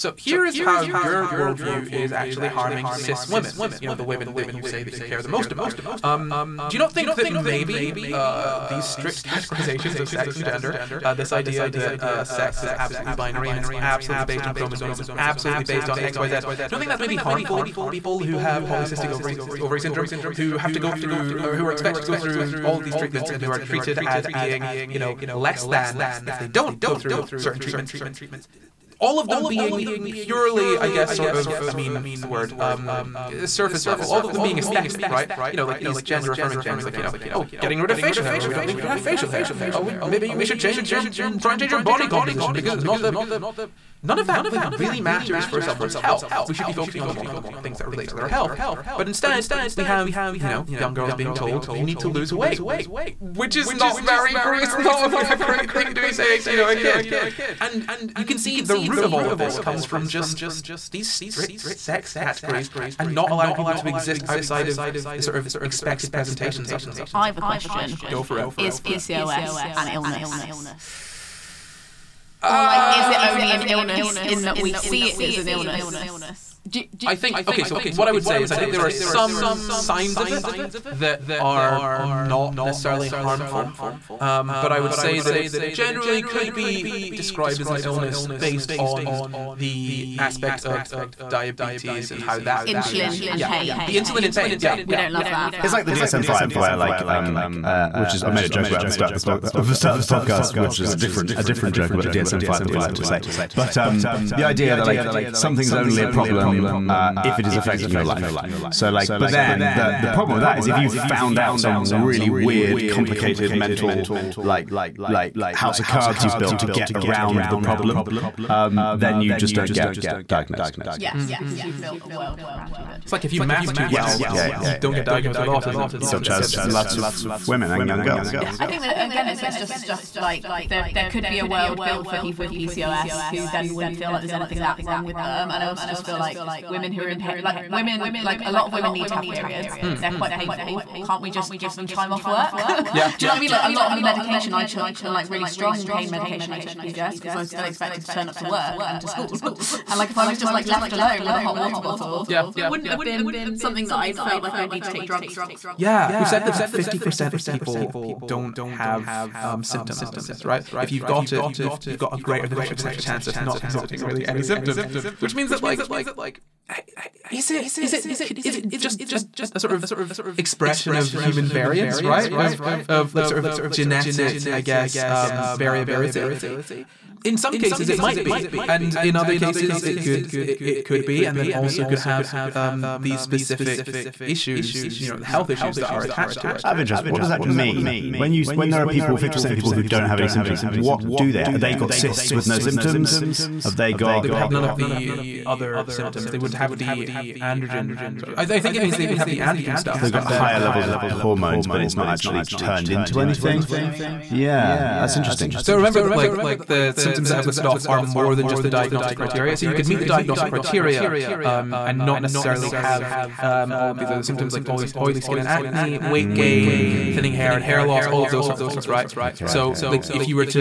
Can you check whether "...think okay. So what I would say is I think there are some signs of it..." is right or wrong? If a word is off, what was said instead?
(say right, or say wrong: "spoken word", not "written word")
right.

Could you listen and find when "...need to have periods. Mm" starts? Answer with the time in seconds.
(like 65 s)
138 s.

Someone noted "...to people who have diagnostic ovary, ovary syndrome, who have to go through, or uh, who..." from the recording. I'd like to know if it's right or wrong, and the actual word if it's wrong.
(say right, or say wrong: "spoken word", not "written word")
wrong: "polycystic", not "diagnostic".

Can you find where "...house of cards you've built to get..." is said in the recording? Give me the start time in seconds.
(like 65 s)
115 s.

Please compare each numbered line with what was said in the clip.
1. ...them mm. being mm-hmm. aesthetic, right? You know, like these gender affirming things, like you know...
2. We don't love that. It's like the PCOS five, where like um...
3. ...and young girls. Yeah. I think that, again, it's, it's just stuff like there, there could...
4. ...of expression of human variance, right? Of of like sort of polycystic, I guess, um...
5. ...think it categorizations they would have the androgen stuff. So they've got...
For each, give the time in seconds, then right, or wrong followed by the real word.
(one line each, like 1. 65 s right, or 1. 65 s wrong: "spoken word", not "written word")
1. 34 s right
2. 94 s wrong: "DSM", not "PCOS"
3. 127 s right
4. 169 s wrong: "genetic", not "polycystic"
5. 198 s wrong: "means", not "categorizations".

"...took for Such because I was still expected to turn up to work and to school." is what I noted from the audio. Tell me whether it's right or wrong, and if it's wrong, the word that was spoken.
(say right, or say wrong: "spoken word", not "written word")
wrong: "PCOS", not "Such".